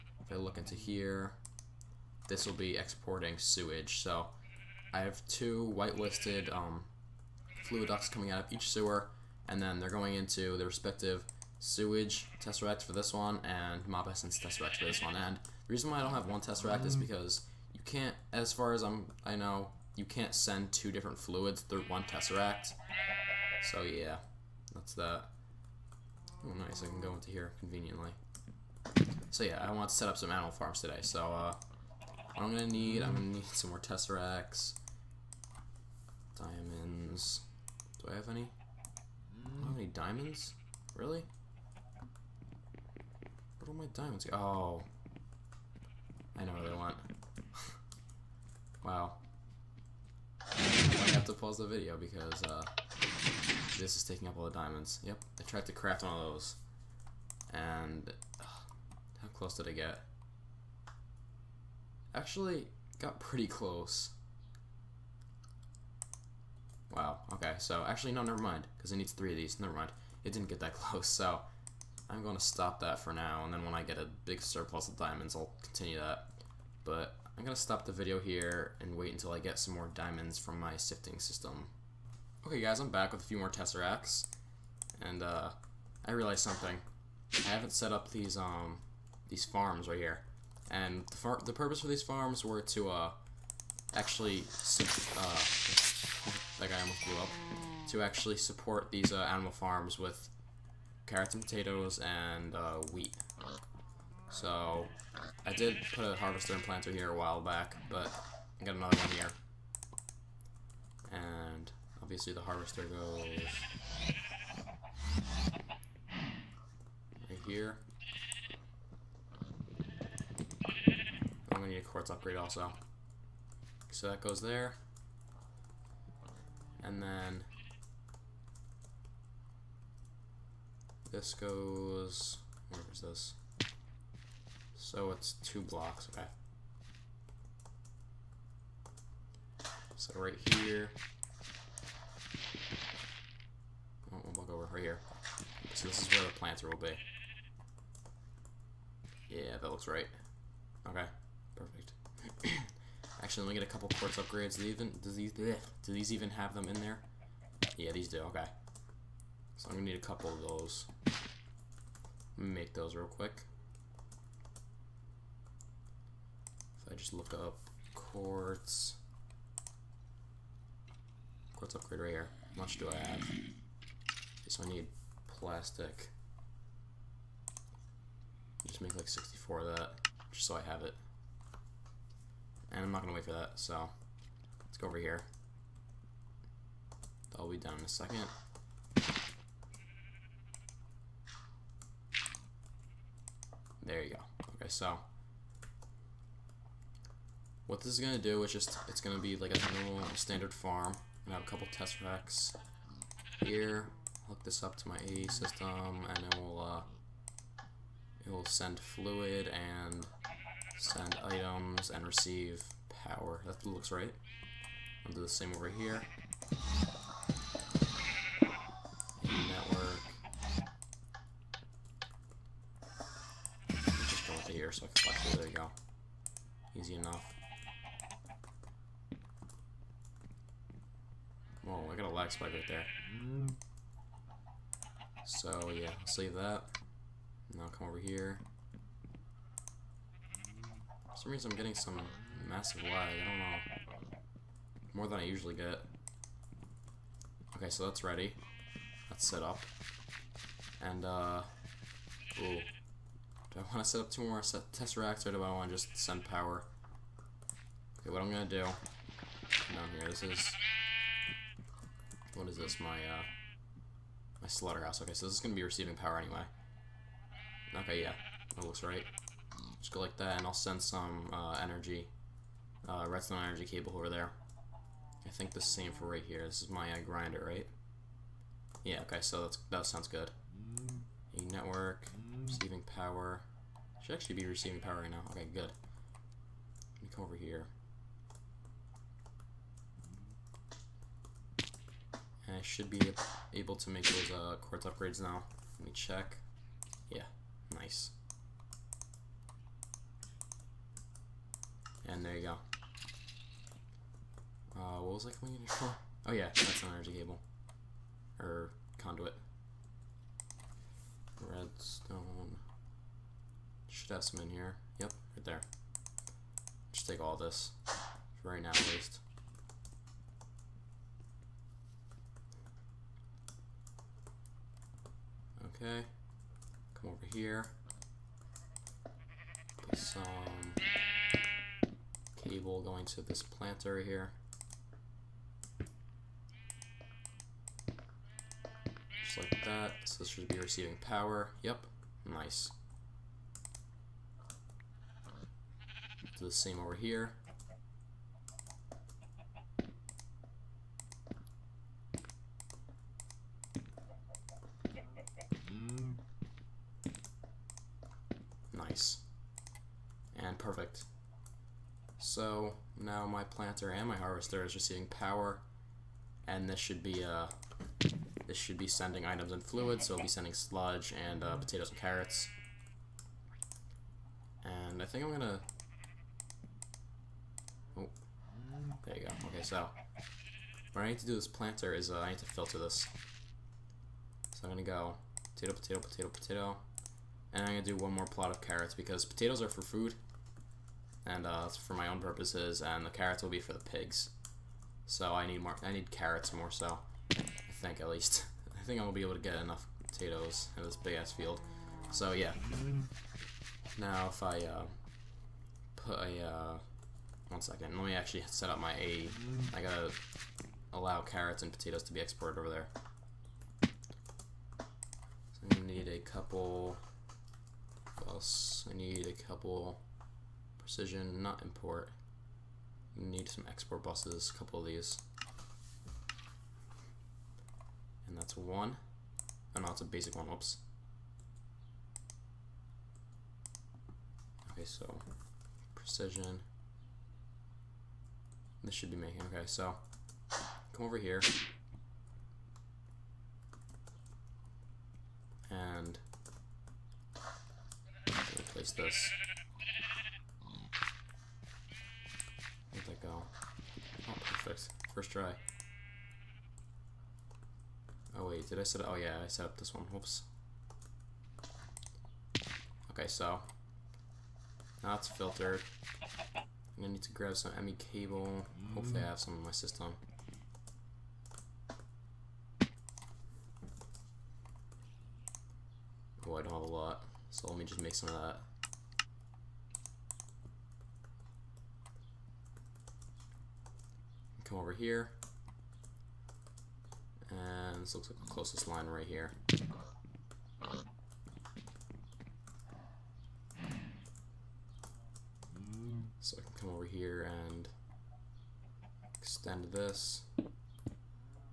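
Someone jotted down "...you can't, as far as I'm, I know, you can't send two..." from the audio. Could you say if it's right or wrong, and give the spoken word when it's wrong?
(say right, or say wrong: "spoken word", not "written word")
right.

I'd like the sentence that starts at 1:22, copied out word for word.
Okay guys, I'm back with a few more tesseracts, and uh, I realized something.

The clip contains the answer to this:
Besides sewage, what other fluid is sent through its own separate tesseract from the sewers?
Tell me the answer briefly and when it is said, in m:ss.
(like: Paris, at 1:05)
Mob essence, at 0:13.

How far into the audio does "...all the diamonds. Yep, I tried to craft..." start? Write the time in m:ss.
0:54.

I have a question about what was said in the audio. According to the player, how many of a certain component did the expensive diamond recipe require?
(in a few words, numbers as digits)
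3.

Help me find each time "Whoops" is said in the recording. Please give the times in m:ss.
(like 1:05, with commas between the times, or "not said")
7:10, 7:40.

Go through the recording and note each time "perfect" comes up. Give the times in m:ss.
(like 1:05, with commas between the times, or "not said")
2:31, 6:00, 7:34.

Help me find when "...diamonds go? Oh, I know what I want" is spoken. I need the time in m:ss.
0:43.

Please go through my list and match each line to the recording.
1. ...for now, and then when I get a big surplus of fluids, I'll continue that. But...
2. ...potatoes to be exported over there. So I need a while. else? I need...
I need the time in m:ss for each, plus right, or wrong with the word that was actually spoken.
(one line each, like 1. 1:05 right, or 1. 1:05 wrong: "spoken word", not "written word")
1. 1:13 wrong: "diamonds", not "fluids"
2. 6:51 wrong: "couple", not "while".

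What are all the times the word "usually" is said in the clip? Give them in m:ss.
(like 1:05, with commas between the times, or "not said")
4:05.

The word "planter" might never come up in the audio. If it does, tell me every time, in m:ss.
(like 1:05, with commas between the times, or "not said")
1:46, 2:26, 5:33, 6:03, 6:21.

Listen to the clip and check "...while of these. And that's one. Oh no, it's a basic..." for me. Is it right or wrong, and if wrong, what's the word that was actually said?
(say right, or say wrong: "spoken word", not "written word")
wrong: "couple", not "while".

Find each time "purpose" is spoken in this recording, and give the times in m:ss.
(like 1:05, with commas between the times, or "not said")
1:31, 6:32.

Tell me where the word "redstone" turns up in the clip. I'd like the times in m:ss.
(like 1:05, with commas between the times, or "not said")
4:33, 5:11.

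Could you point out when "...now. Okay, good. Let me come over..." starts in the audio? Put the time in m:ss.
4:45.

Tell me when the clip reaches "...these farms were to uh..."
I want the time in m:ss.
1:31.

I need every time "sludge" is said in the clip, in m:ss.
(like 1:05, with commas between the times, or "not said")
6:10.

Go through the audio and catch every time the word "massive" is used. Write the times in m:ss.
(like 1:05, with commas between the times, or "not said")
4:02.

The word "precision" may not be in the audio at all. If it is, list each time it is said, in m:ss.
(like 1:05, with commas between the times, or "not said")
7:00, 7:15.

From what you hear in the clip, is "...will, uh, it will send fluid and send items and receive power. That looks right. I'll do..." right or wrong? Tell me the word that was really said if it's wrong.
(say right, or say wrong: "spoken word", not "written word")
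right.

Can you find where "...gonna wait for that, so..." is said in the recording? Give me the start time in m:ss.
3:03.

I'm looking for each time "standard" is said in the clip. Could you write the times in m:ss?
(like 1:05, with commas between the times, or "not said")
3:20.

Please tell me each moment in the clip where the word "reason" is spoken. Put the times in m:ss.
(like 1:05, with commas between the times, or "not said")
0:15, 4:01.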